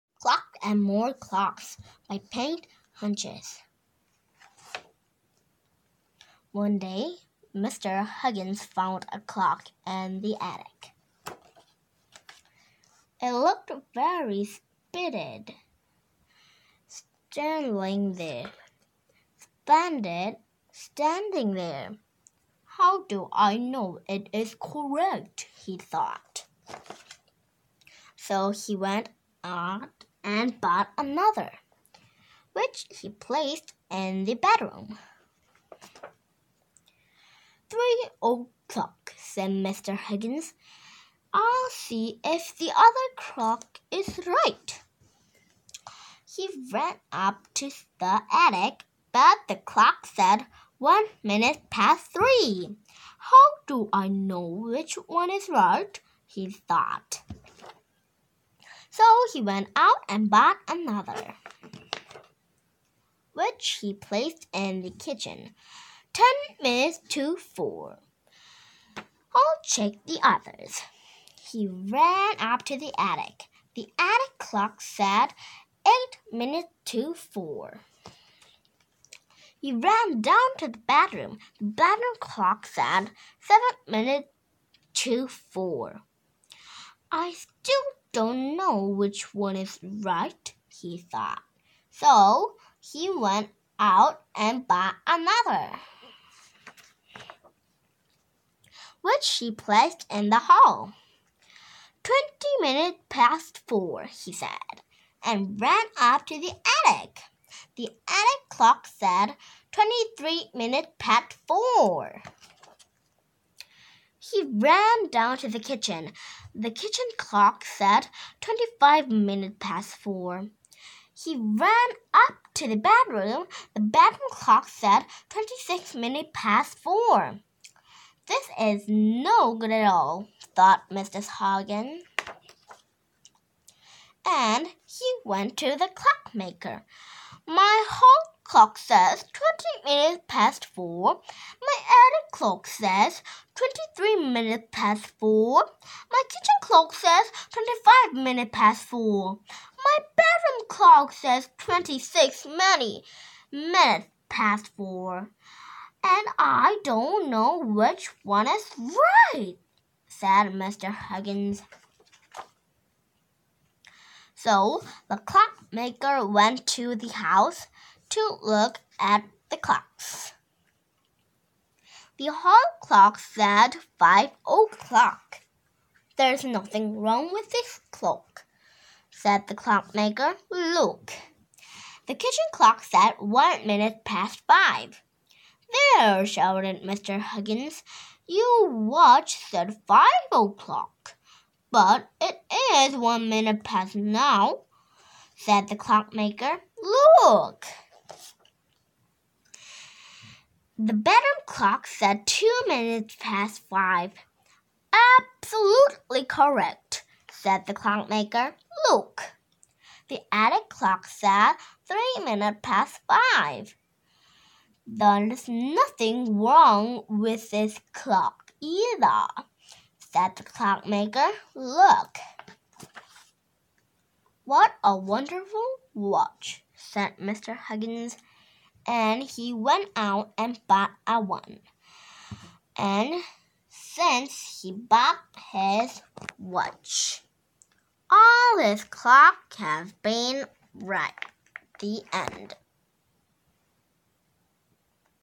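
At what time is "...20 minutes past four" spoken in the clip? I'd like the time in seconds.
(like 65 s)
139 s.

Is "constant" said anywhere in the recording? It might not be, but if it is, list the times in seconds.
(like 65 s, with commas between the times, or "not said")
not said.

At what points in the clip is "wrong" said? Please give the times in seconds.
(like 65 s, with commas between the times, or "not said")
176 s, 216 s.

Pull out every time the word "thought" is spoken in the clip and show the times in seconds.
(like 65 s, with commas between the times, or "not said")
25 s, 56 s, 90 s, 130 s.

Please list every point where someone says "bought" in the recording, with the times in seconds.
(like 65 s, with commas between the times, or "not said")
30 s, 60 s, 94 s, 230 s, 234 s.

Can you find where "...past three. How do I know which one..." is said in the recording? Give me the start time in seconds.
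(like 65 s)
51 s.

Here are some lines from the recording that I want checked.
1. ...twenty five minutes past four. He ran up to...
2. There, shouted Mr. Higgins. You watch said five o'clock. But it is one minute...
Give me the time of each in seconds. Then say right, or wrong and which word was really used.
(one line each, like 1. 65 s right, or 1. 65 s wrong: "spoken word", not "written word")
1. 118 s right
2. 185 s right.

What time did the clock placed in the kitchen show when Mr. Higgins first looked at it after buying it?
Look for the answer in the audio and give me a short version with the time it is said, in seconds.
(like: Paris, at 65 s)
Ten minutes to four, at 66 s.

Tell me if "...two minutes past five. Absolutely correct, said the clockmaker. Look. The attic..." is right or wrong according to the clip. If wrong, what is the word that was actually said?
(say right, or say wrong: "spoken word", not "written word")
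right.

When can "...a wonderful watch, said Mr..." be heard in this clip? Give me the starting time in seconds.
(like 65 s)
224 s.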